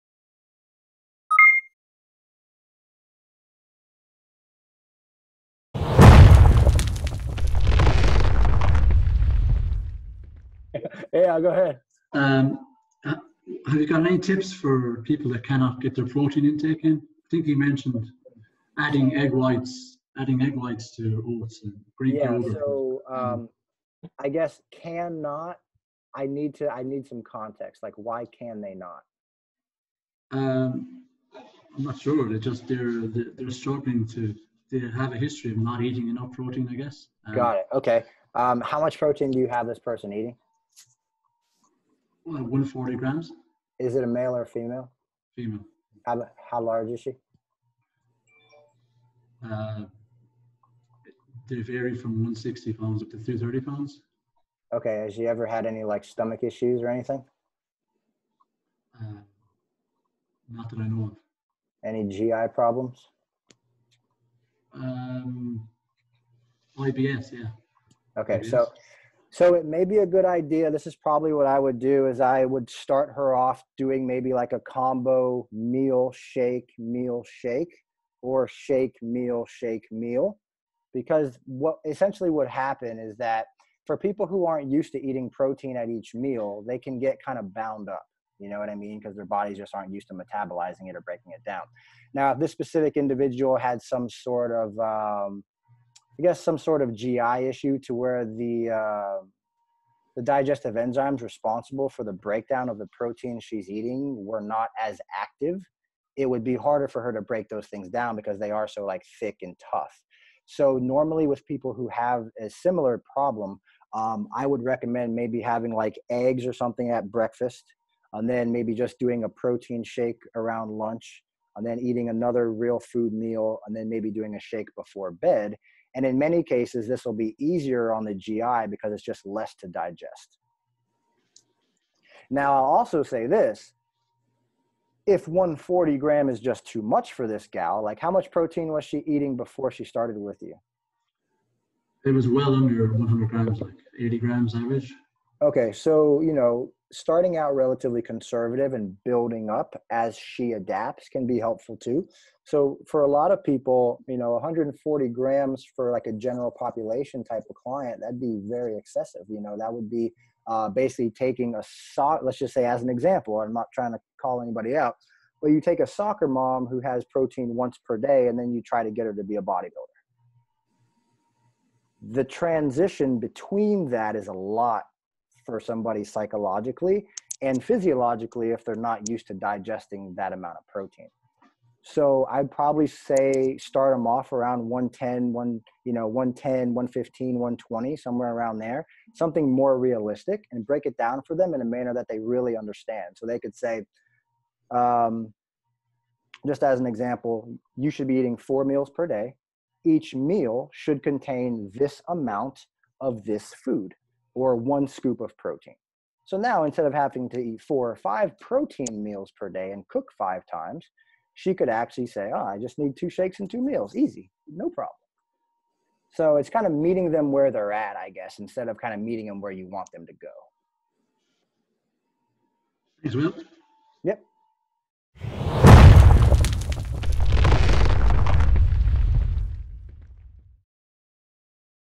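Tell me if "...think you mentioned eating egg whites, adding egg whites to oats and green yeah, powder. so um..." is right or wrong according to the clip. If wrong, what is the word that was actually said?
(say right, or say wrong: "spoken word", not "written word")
wrong: "adding", not "eating".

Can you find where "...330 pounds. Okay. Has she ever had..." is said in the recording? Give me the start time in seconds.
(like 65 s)
53 s.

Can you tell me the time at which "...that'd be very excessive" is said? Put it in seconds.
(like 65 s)
158 s.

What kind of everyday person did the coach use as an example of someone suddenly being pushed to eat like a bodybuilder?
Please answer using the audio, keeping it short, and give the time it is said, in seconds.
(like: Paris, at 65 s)
soccer mom, at 165 s.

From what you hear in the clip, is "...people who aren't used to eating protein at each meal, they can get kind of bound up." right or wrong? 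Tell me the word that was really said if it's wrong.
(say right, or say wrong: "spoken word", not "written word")
right.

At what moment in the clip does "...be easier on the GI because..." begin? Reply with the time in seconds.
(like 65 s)
127 s.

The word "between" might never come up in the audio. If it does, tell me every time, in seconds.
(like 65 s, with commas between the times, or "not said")
173 s.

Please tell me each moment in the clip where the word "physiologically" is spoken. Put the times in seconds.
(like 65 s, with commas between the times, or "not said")
177 s.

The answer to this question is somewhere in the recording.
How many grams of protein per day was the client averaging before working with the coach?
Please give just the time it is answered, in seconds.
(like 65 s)
143 s.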